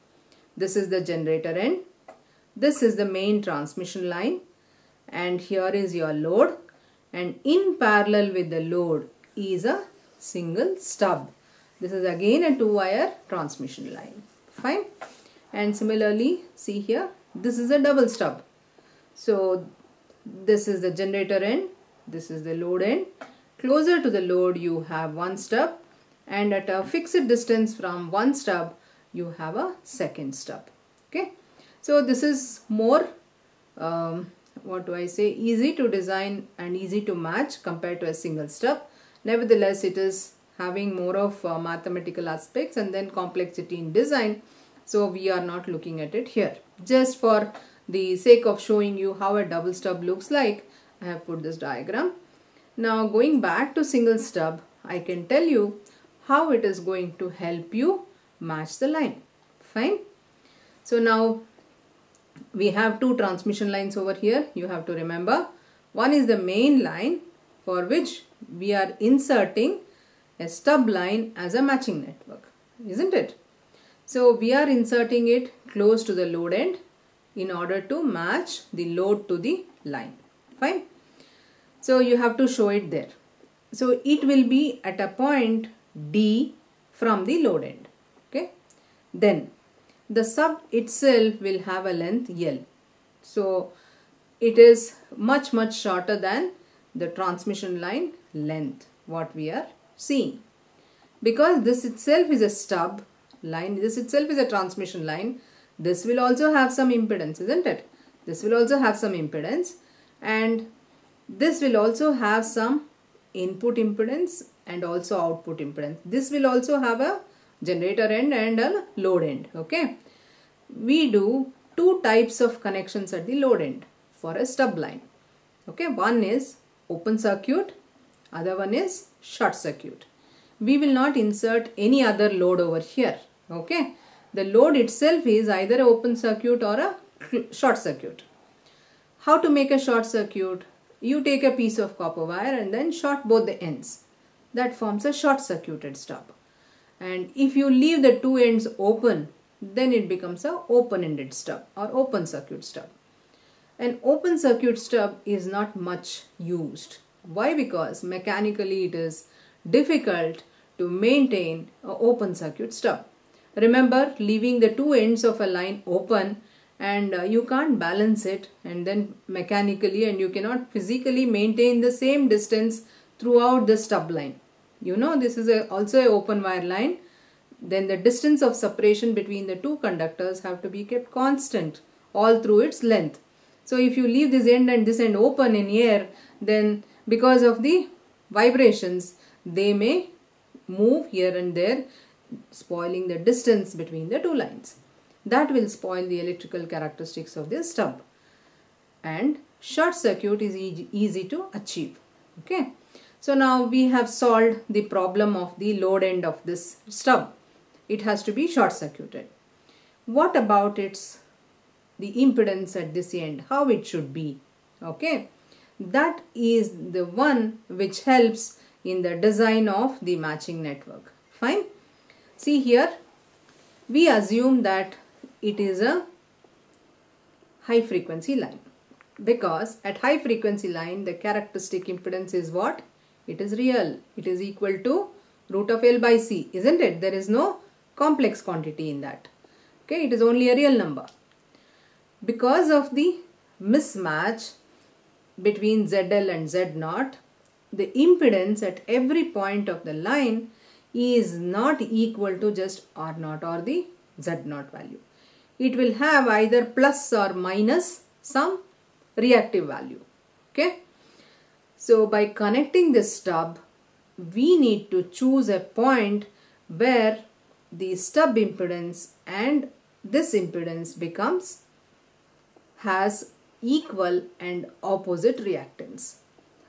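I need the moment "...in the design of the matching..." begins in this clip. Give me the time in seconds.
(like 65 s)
218 s.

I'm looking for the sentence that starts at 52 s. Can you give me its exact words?
Now going back to single stub, I can tell you how it is going to help you match the line.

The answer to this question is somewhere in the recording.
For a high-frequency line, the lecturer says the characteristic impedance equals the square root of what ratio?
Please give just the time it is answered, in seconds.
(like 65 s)
235 s.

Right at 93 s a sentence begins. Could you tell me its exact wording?
So it is much much shorter than the transmission line length what we are seeing.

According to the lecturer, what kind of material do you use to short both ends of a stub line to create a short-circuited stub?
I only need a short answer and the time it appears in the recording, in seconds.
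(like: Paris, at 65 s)
copper wire, at 141 s.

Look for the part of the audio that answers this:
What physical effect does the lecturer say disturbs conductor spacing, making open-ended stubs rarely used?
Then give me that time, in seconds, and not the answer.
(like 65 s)
188 s.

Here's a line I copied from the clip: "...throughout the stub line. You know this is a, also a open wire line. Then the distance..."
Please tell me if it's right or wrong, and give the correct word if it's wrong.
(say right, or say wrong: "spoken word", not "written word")
right.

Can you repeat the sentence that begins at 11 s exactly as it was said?
This is again a two wire transmission line.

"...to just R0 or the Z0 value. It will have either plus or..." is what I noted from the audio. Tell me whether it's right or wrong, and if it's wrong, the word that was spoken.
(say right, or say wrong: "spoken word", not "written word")
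right.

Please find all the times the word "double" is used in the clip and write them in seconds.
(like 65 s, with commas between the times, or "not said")
17 s, 49 s.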